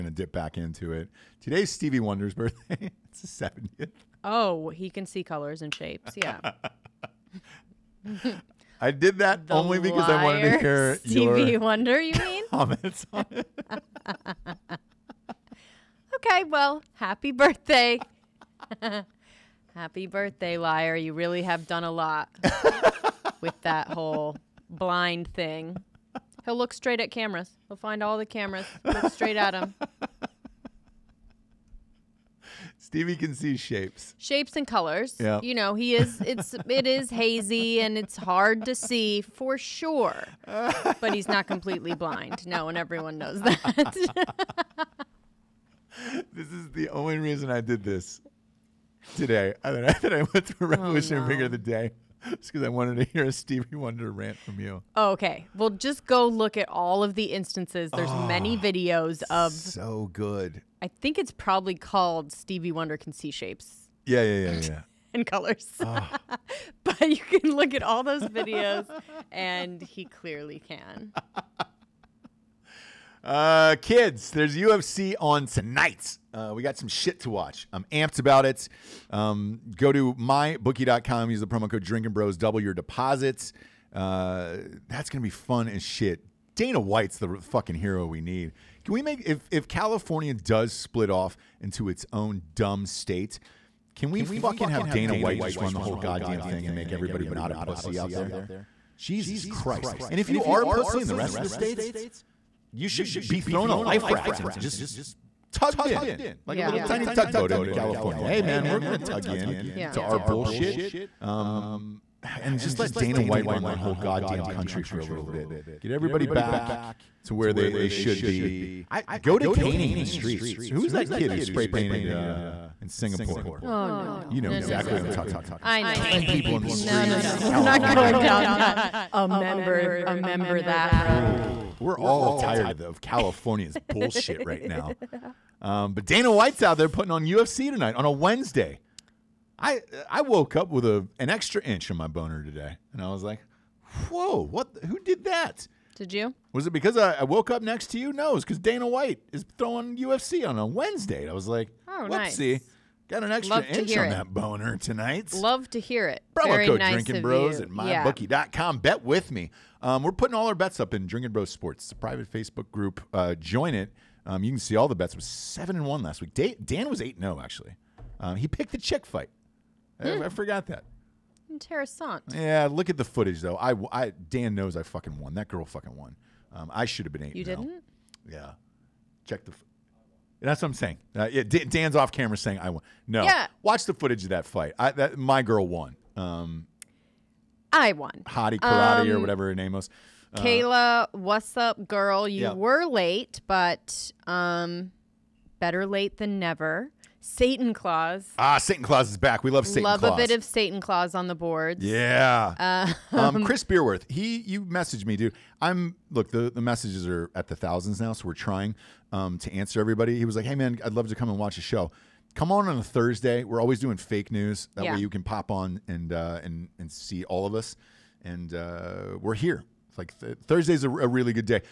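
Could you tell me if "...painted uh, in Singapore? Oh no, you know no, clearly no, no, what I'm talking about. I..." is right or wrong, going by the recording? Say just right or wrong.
wrong.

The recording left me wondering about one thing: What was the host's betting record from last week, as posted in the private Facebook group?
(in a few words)
7 and 1.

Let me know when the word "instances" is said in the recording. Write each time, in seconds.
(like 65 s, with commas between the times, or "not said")
57 s.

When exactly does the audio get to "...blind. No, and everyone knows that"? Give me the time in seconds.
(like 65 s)
41 s.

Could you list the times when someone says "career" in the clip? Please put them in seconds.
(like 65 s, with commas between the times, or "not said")
not said.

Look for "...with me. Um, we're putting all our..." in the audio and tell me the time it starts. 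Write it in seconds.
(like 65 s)
159 s.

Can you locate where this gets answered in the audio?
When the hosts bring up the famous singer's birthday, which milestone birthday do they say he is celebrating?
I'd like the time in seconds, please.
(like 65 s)
3 s.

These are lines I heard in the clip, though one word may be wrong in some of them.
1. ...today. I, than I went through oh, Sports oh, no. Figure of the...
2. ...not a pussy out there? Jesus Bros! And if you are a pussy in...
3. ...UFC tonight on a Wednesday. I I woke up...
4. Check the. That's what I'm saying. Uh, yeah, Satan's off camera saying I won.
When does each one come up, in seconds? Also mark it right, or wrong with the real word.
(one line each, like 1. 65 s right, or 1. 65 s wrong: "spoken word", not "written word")
1. 49 s wrong: "Revolutionary", not "Sports"
2. 97 s wrong: "Christ", not "Bros"
3. 137 s right
4. 179 s wrong: "Dan", not "Satan".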